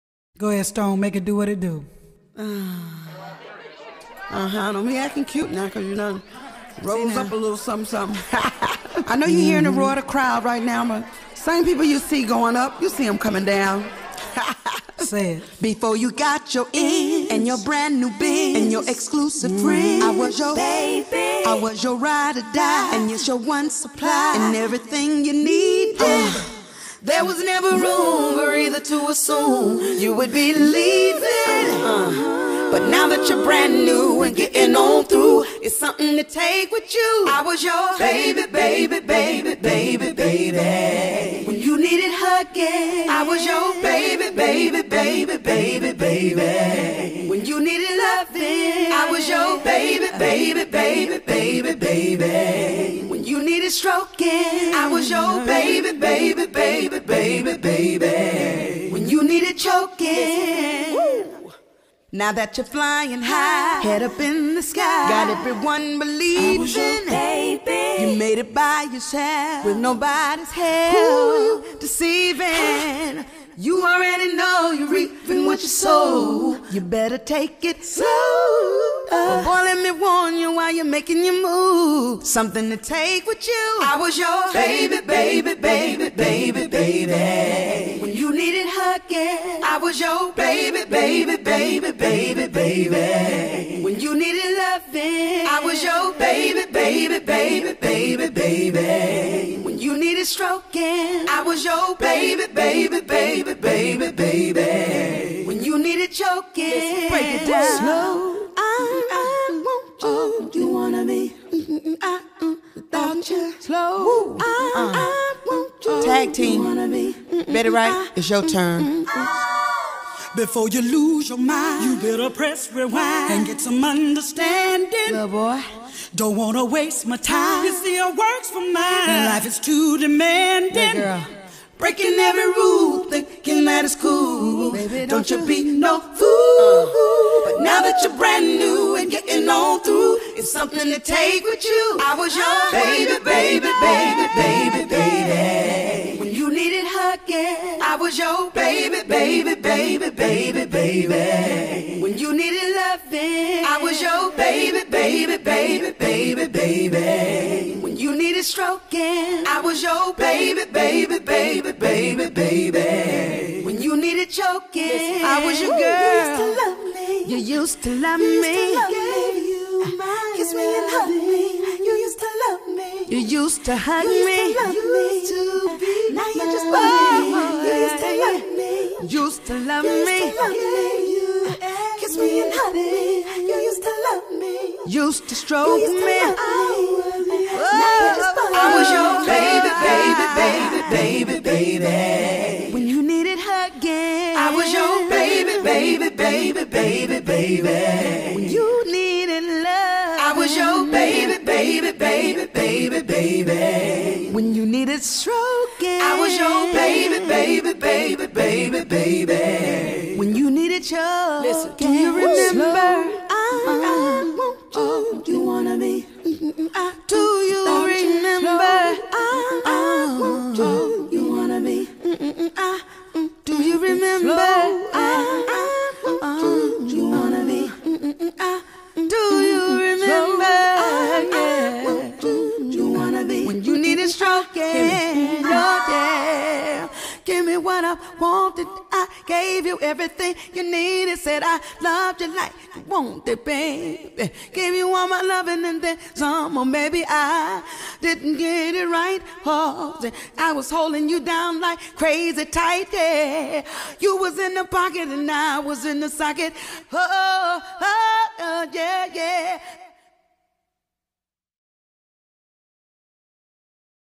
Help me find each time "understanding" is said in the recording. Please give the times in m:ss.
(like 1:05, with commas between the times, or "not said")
2:03.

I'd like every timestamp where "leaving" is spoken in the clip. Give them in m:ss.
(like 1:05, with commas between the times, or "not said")
0:30.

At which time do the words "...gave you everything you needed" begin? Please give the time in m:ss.
3:59.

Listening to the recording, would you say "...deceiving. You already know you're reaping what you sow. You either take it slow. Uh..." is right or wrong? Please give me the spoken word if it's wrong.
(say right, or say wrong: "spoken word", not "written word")
wrong: "better", not "either".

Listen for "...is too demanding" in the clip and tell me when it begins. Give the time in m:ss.
2:09.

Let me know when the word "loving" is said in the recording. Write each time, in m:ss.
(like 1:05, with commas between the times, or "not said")
0:47, 1:34, 2:32, 4:05.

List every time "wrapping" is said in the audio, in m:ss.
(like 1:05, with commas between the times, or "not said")
not said.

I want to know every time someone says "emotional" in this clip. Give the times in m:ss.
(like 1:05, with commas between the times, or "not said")
not said.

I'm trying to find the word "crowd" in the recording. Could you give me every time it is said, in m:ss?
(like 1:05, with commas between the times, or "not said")
0:10.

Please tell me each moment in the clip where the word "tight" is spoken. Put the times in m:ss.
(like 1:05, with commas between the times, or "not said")
4:12.